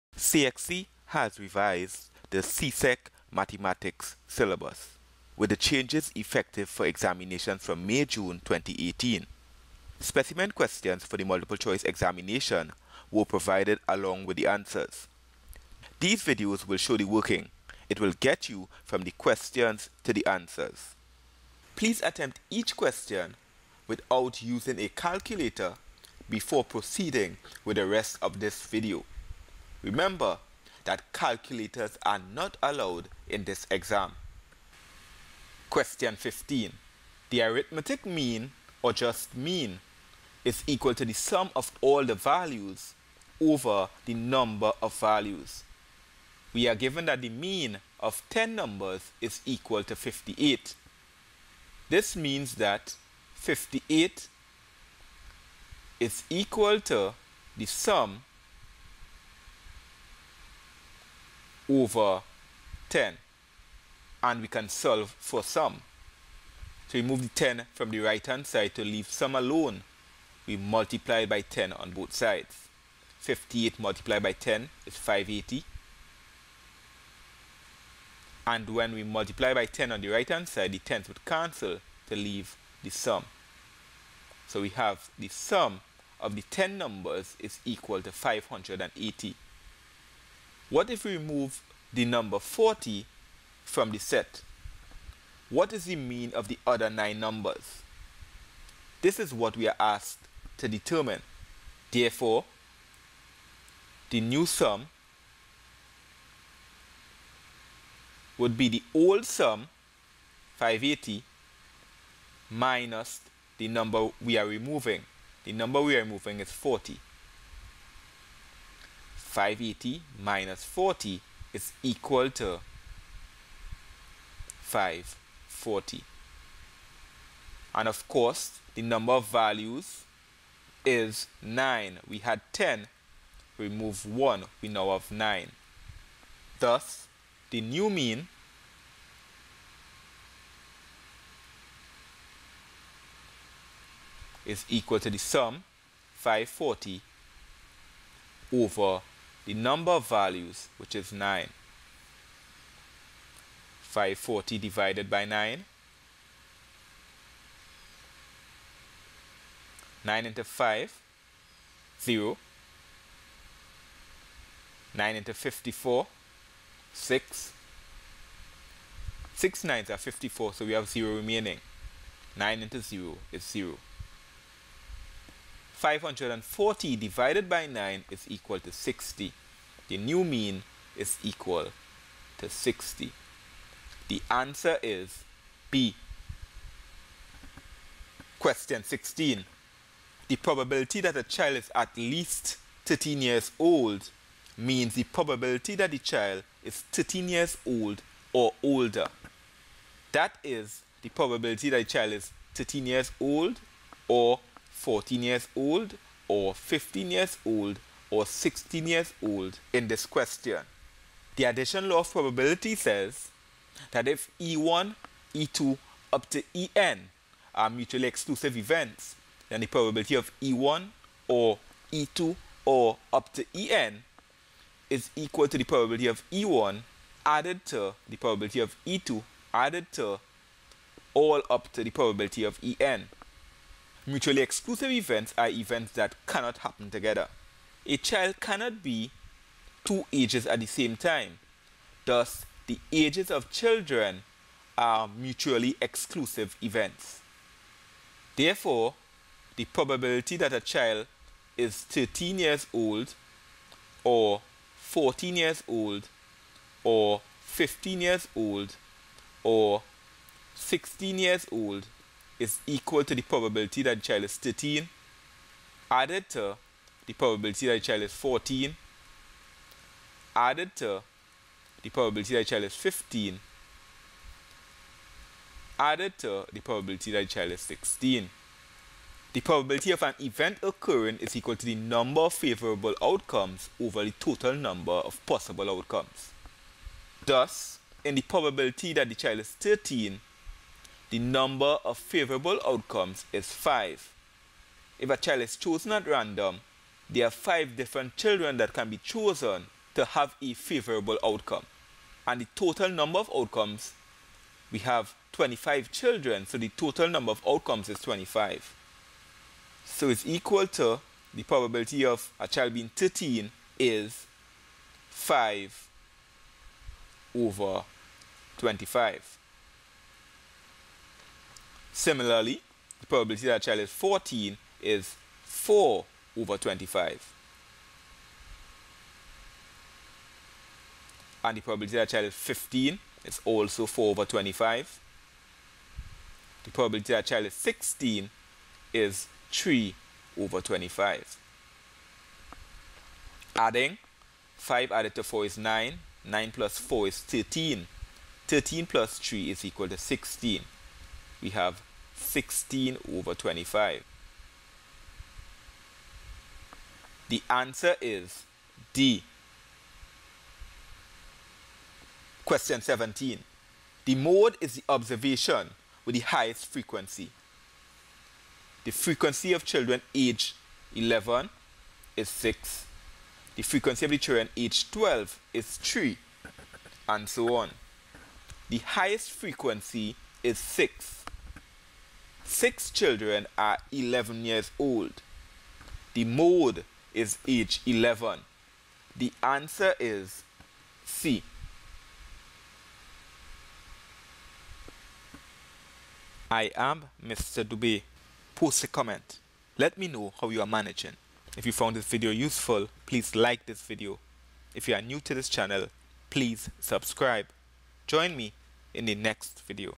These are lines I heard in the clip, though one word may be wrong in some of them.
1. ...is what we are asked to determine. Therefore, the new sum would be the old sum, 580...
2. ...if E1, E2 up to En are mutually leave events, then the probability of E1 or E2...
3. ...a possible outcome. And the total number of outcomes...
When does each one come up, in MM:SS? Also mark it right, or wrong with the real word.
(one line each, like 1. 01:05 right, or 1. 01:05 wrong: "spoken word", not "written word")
1. 01:39 right
2. 03:34 wrong: "exclusive", not "leave"
3. 05:00 wrong: "favorable", not "possible".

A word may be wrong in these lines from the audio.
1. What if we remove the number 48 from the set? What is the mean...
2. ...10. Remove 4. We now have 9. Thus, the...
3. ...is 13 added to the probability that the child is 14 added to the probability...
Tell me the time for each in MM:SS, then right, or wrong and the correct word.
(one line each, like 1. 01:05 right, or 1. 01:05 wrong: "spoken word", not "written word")
1. 01:30 wrong: "40", not "48"
2. 02:12 wrong: "1", not "4"
3. 04:24 right.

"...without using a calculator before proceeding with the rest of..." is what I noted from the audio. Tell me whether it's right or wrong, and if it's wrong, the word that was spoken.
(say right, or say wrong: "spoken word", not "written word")
right.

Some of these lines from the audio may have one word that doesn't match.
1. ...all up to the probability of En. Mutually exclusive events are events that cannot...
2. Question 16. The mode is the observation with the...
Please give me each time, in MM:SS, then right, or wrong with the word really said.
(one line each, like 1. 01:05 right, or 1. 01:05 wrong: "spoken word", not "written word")
1. 03:51 right
2. 06:02 wrong: "17", not "16".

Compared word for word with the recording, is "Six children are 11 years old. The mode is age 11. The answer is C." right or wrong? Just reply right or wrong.
right.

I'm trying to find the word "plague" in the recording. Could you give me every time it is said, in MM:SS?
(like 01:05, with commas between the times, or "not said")
not said.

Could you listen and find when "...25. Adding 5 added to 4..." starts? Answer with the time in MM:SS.
05:40.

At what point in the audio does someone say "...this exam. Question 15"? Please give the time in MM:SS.
00:33.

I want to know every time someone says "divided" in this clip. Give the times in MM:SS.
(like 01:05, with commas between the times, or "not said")
02:34, 02:56.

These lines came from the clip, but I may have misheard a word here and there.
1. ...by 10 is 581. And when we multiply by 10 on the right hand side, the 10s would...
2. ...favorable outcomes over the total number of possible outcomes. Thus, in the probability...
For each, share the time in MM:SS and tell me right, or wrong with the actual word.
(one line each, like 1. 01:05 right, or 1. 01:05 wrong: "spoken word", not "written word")
1. 01:14 wrong: "580", not "581"
2. 04:42 right.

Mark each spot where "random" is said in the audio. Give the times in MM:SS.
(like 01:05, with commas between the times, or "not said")
04:56.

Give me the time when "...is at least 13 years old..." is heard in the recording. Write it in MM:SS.
03:11.